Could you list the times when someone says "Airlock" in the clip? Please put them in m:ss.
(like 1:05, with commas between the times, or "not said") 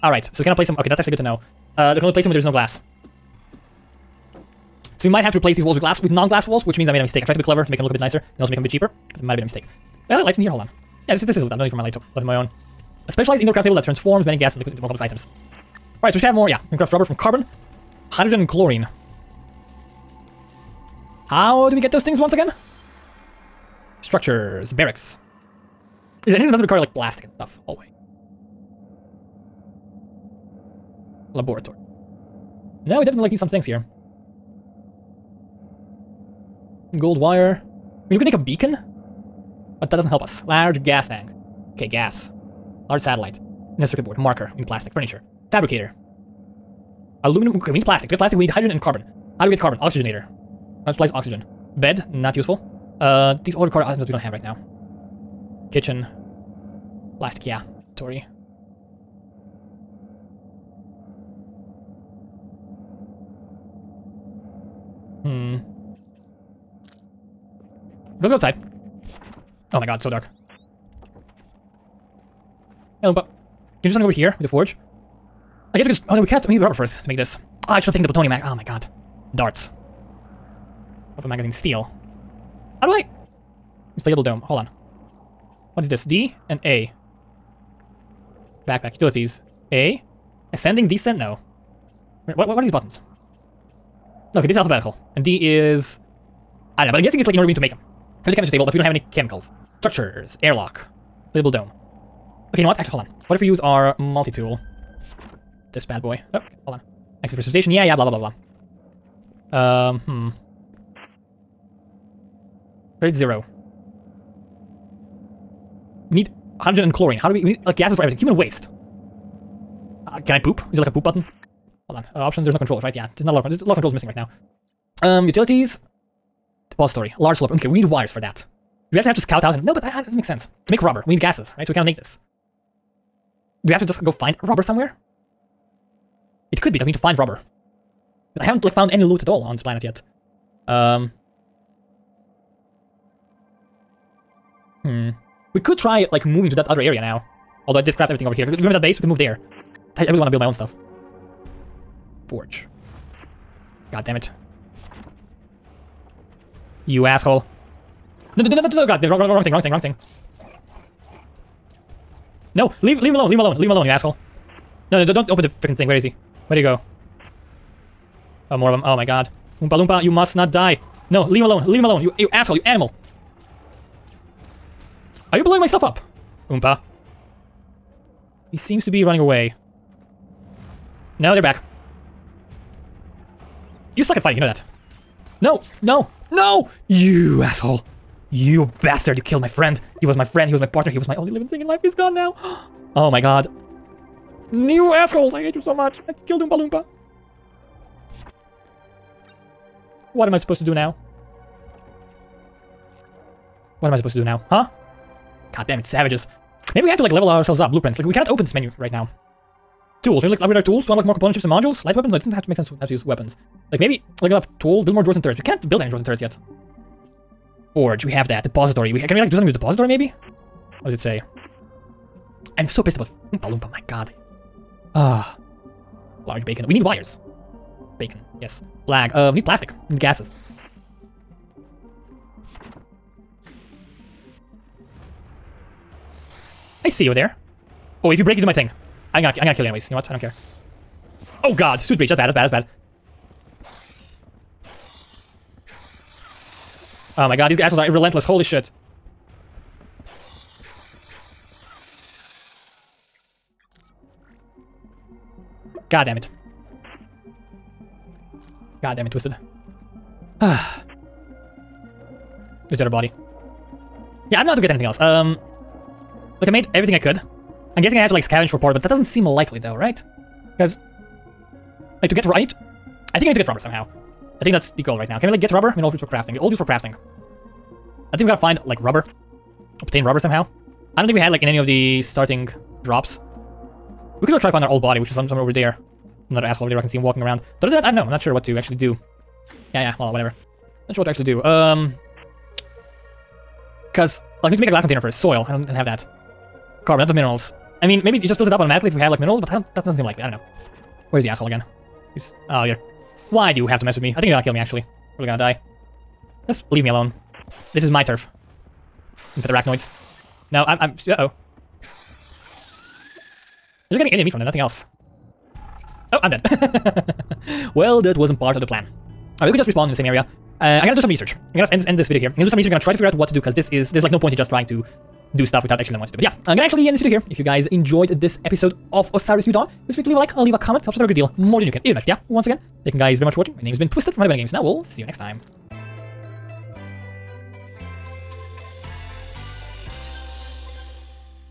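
1:40.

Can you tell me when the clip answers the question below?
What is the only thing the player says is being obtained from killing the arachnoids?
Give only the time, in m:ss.
5:14.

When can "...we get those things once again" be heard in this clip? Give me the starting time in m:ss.
0:21.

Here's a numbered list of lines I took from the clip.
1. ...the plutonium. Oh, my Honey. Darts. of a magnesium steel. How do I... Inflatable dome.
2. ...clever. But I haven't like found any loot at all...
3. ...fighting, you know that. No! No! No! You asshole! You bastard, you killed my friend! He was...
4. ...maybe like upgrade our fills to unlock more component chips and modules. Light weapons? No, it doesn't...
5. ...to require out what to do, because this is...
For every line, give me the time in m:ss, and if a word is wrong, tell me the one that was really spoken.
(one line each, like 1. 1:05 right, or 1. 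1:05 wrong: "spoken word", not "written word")
1. 1:18 wrong: "God", not "Honey"
2. 2:17 wrong: "rubber", not "clever"
3. 3:04 right
4. 3:30 wrong: "tools", not "fills"
5. 5:22 wrong: "figure", not "require".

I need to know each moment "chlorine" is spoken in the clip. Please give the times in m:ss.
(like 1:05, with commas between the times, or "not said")
0:18, 1:56.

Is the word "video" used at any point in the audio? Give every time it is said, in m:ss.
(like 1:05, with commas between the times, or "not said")
5:22, 5:26.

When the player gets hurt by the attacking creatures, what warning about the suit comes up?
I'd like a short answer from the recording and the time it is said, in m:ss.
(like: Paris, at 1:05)
Suit breach, at 4:01.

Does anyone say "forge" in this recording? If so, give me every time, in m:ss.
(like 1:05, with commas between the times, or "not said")
1:14, 2:32, 3:37.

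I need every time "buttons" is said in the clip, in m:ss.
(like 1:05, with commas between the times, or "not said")
1:32, 2:01.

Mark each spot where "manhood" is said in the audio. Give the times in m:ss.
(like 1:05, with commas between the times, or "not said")
not said.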